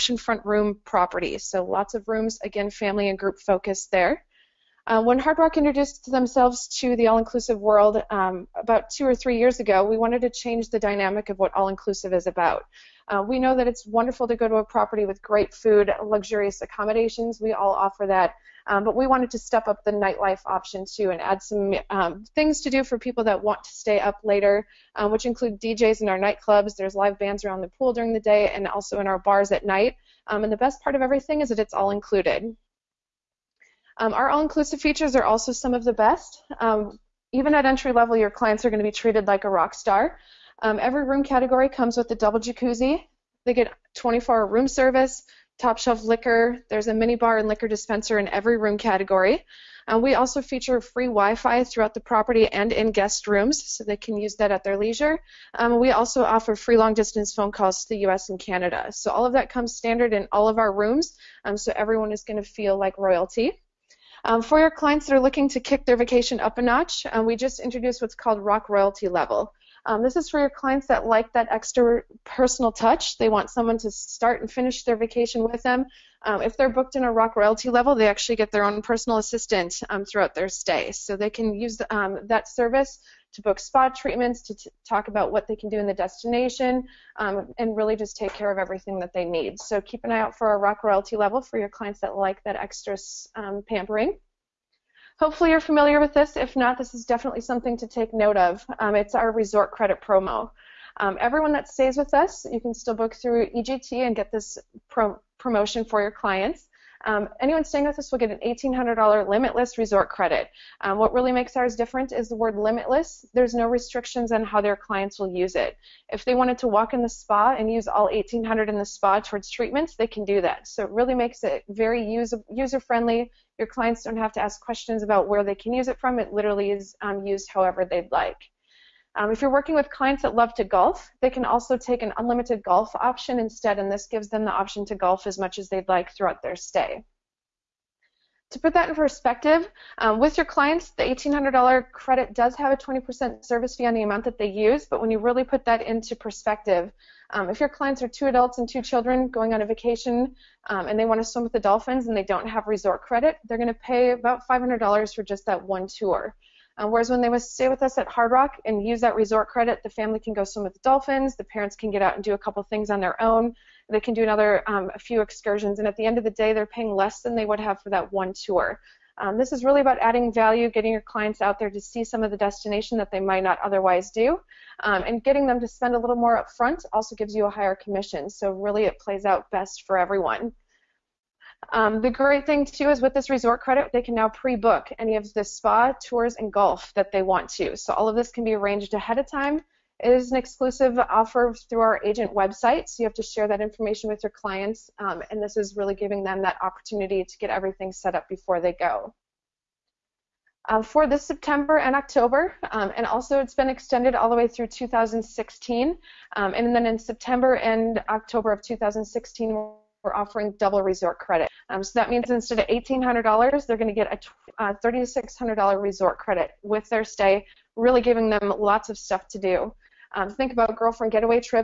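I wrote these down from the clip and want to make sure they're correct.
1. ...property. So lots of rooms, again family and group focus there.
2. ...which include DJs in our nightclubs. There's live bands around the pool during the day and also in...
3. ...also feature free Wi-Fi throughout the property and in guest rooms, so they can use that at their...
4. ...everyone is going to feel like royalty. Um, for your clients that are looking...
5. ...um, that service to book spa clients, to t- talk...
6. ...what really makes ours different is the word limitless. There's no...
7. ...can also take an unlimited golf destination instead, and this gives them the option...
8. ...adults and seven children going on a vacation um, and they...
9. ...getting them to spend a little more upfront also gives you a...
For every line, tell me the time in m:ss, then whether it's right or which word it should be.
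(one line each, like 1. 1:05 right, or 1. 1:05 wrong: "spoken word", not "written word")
1. 0:00 right
2. 0:25 right
3. 0:50 right
4. 1:01 right
5. 1:21 wrong: "treatments", not "clients"
6. 1:50 right
7. 2:11 wrong: "option", not "destination"
8. 2:28 wrong: "two", not "seven"
9. 2:55 right.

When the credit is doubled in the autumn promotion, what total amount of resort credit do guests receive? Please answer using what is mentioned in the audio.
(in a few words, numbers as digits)
$3,600.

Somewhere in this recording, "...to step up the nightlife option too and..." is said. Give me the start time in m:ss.
0:19.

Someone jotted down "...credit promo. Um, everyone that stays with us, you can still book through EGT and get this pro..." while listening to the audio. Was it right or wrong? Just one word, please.
right.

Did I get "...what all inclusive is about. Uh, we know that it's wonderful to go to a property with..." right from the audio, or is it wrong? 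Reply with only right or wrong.
right.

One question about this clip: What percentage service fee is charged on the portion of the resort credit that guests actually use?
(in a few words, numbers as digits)
20%.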